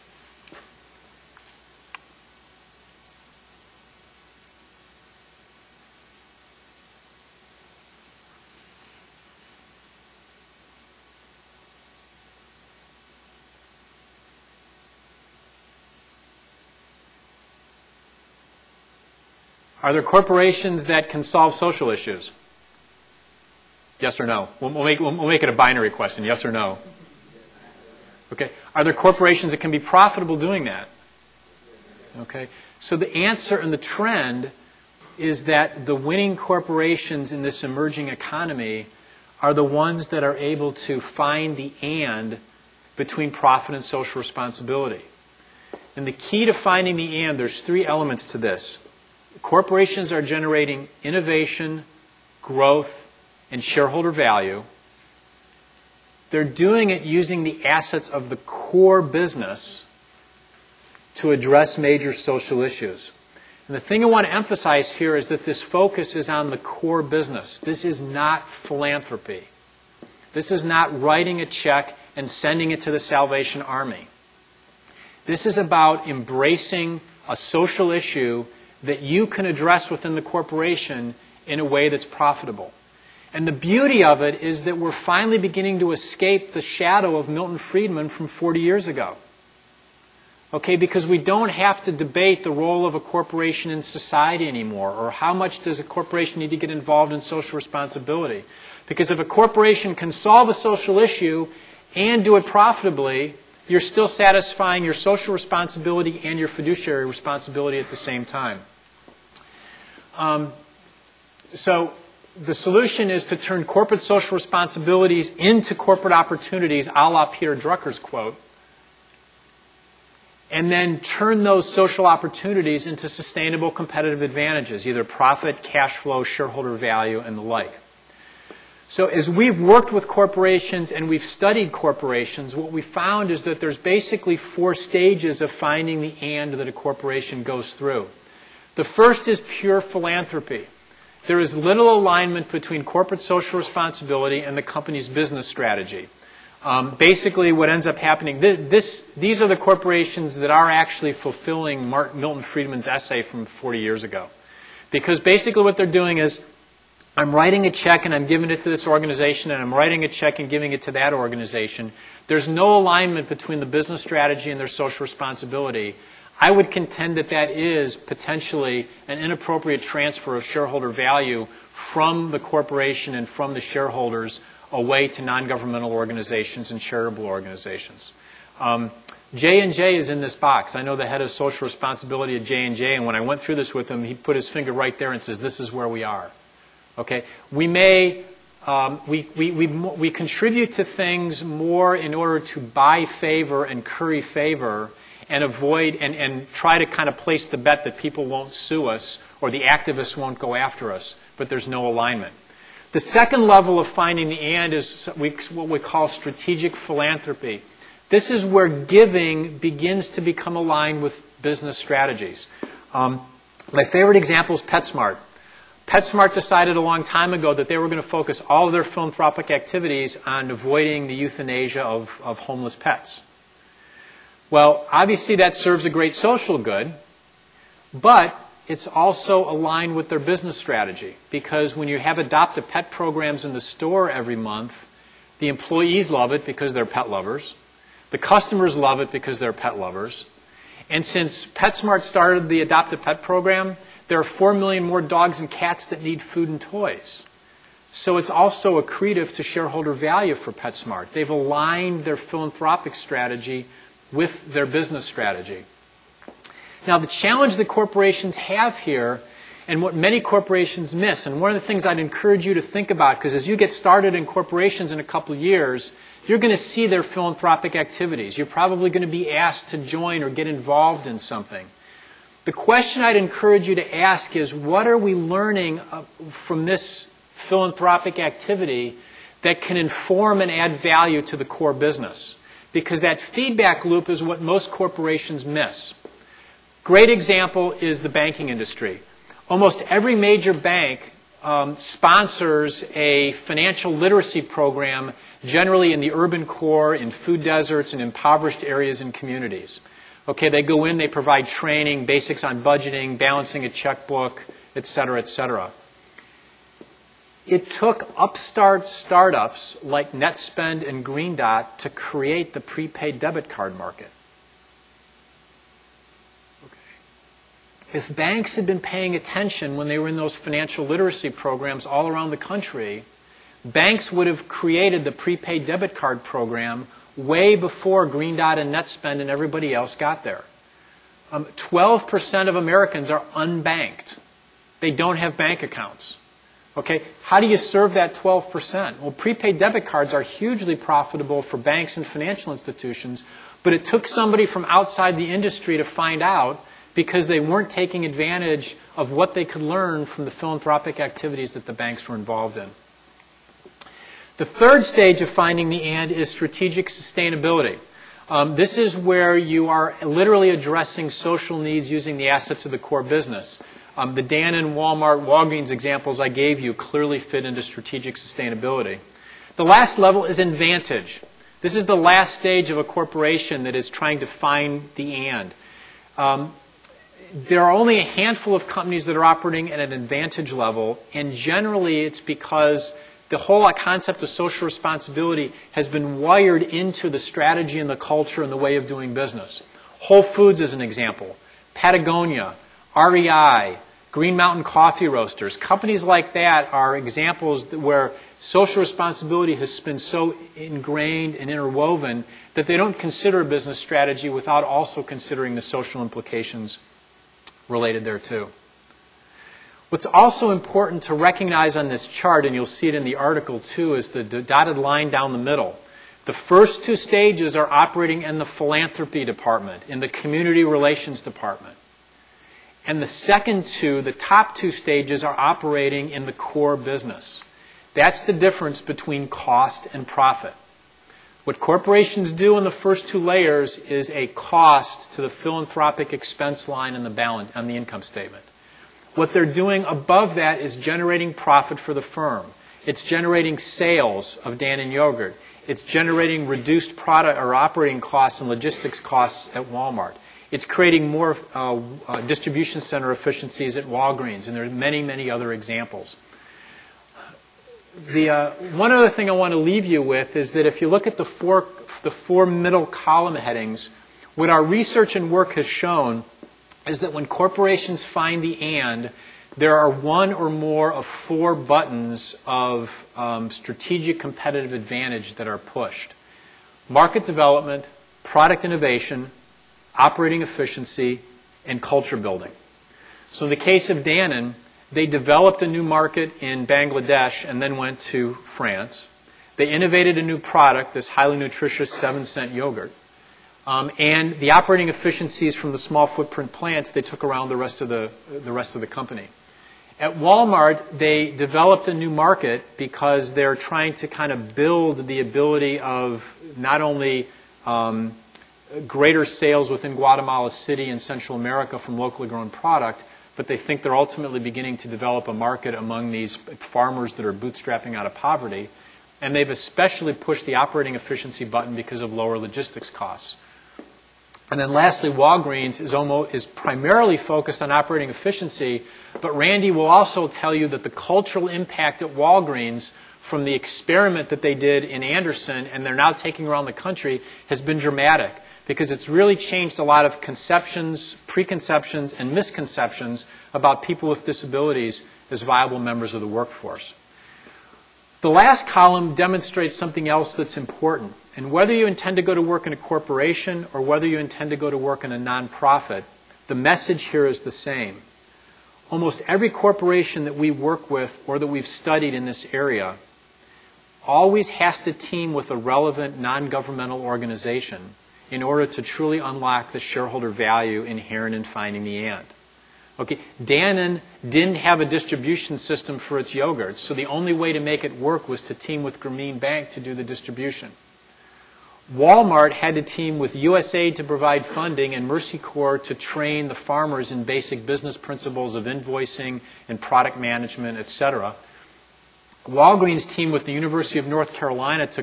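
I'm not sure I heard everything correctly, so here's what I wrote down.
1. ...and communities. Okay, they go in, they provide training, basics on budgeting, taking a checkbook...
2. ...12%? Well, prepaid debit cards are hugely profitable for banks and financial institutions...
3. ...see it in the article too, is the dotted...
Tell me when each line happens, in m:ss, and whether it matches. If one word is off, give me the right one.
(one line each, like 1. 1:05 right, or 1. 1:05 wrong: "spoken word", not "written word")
1. 4:59 wrong: "balancing", not "taking"
2. 5:38 right
3. 6:52 right.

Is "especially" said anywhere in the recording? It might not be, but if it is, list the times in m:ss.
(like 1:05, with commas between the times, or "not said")
8:39.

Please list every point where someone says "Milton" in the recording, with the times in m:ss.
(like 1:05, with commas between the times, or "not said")
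1:27, 2:31.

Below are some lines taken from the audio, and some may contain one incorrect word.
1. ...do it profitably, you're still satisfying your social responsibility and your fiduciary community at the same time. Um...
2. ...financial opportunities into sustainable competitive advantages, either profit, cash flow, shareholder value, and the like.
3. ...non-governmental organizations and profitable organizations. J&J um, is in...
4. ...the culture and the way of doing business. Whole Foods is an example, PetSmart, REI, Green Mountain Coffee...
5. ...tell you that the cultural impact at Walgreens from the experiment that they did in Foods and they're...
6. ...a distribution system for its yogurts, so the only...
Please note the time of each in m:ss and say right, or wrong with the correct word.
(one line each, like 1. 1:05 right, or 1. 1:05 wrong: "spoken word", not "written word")
1. 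1:42 wrong: "responsibility", not "community"
2. 2:01 wrong: "social", not "financial"
3. 2:55 wrong: "charitable", not "profitable"
4. 6:27 wrong: "Patagonia", not "PetSmart"
5. 8:50 wrong: "Anderson", not "Foods"
6. 9:34 right.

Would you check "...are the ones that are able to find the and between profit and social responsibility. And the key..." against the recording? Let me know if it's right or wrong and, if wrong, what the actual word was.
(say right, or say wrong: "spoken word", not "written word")
right.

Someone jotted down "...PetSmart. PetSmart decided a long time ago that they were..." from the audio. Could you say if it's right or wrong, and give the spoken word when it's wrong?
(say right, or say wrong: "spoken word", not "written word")
right.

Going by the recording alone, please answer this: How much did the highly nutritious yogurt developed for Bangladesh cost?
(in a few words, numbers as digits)
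7 cents.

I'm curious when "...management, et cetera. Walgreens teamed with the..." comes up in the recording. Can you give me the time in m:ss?
9:50.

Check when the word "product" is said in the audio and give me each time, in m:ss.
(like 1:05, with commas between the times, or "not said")
7:26, 7:58, 8:10, 8:32, 9:49.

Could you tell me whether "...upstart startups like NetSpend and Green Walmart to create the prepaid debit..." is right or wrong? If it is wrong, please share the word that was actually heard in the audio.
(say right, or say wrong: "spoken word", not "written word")
wrong: "Dot", not "Walmart".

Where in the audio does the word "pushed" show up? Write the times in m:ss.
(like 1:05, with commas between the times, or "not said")
7:55, 8:40.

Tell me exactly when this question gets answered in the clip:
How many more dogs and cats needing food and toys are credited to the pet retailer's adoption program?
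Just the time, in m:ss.
4:04.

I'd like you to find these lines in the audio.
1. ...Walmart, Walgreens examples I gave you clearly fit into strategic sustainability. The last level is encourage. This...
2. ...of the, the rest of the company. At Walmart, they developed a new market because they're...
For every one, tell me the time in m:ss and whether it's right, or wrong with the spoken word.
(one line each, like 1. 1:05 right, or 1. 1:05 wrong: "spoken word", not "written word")
1. 6:04 wrong: "advantage", not "encourage"
2. 8:17 right.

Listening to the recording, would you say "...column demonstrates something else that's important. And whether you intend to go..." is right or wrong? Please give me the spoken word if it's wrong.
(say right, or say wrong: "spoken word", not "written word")
right.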